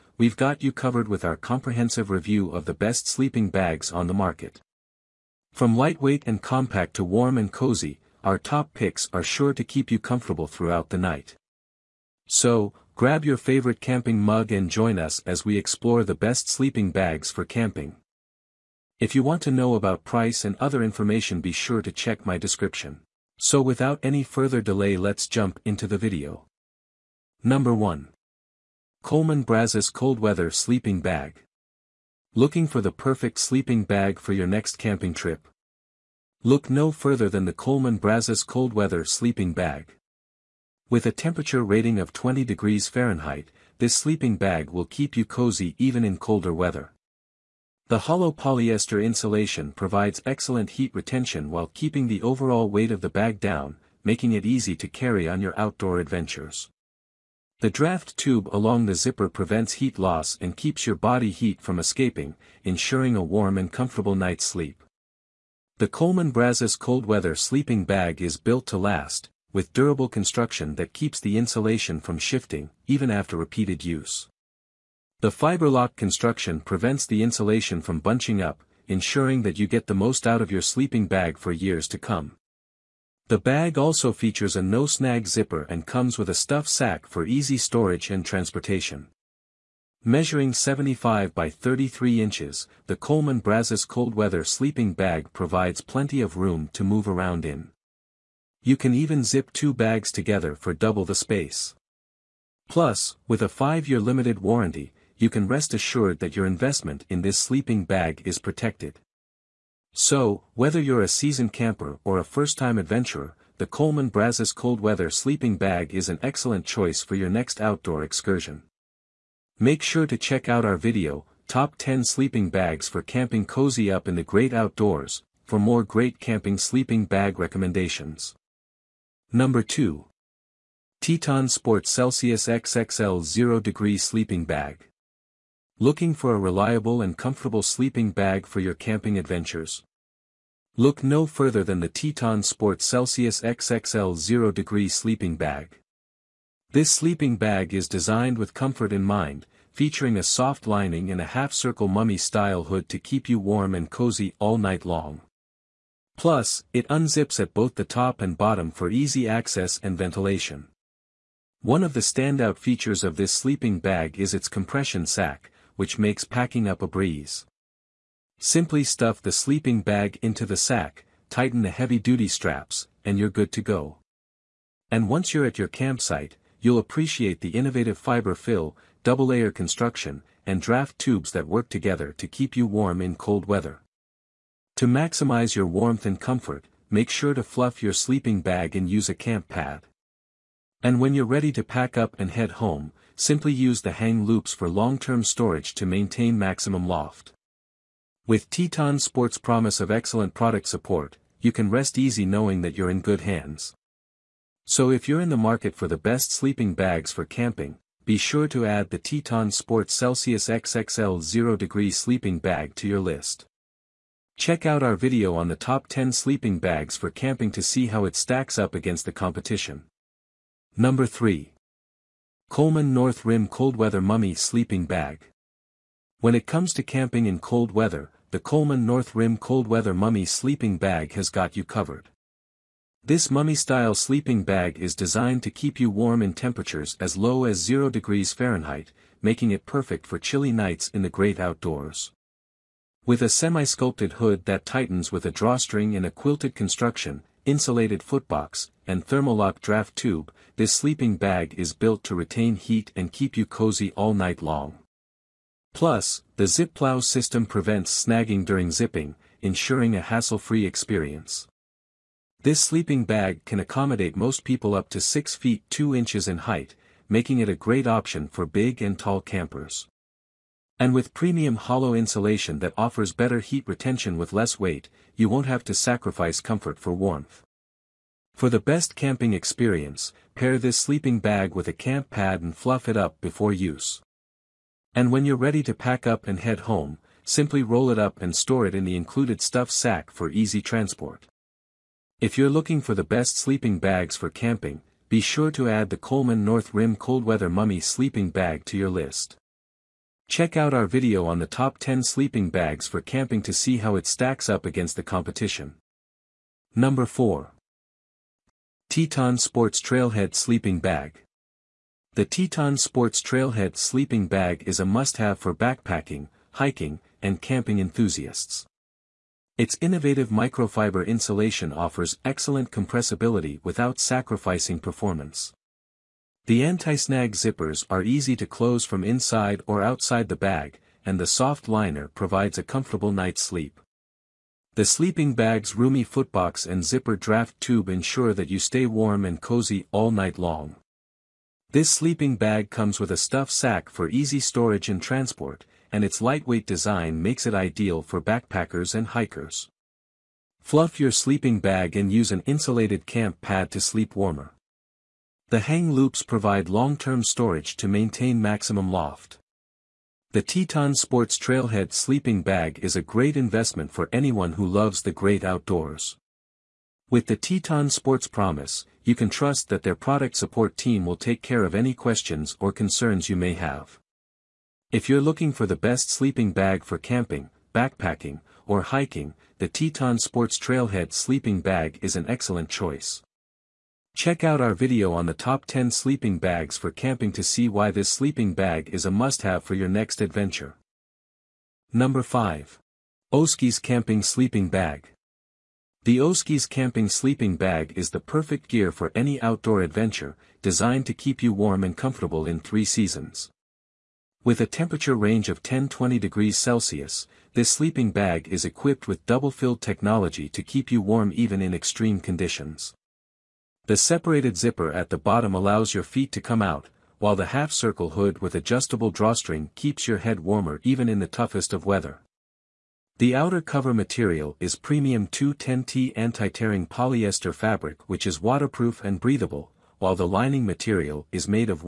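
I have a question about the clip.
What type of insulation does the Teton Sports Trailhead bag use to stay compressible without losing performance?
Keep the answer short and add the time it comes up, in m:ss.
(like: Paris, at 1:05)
Microfiber, at 5:20.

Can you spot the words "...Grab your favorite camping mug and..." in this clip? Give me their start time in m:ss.
0:12.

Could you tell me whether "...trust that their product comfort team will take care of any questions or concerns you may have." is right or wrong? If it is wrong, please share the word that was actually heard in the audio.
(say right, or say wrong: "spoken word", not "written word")
wrong: "support", not "comfort".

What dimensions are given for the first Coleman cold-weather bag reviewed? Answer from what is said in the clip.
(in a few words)
75 by 33 inches.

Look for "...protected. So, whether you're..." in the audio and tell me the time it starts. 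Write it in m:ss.
1:48.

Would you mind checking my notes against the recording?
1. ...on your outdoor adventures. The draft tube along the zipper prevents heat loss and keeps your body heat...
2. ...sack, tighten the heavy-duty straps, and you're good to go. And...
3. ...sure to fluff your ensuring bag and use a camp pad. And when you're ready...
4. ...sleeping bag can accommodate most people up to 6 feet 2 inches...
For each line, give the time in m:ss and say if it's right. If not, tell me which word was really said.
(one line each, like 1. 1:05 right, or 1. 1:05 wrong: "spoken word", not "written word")
1. 0:55 right
2. 2:50 right
3. 3:07 wrong: "sleeping", not "ensuring"
4. 4:22 right.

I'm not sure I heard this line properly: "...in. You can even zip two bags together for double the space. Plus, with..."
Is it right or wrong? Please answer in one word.
right.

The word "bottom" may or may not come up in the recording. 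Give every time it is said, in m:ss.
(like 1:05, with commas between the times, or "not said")
2:38, 6:55.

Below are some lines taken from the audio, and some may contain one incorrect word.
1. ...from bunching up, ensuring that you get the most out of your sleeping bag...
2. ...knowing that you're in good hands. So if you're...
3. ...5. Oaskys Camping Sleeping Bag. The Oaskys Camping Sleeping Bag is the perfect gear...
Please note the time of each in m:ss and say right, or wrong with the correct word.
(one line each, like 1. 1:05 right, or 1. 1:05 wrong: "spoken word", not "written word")
1. 1:17 right
2. 3:22 right
3. 6:32 right.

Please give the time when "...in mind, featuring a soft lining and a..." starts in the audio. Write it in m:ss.
2:28.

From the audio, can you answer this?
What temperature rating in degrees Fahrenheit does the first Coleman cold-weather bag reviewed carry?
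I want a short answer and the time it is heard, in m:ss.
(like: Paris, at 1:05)
20, at 0:42.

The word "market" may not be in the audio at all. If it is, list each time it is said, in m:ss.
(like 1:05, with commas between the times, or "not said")
0:04, 3:25.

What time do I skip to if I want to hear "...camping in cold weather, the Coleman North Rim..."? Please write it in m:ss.
3:46.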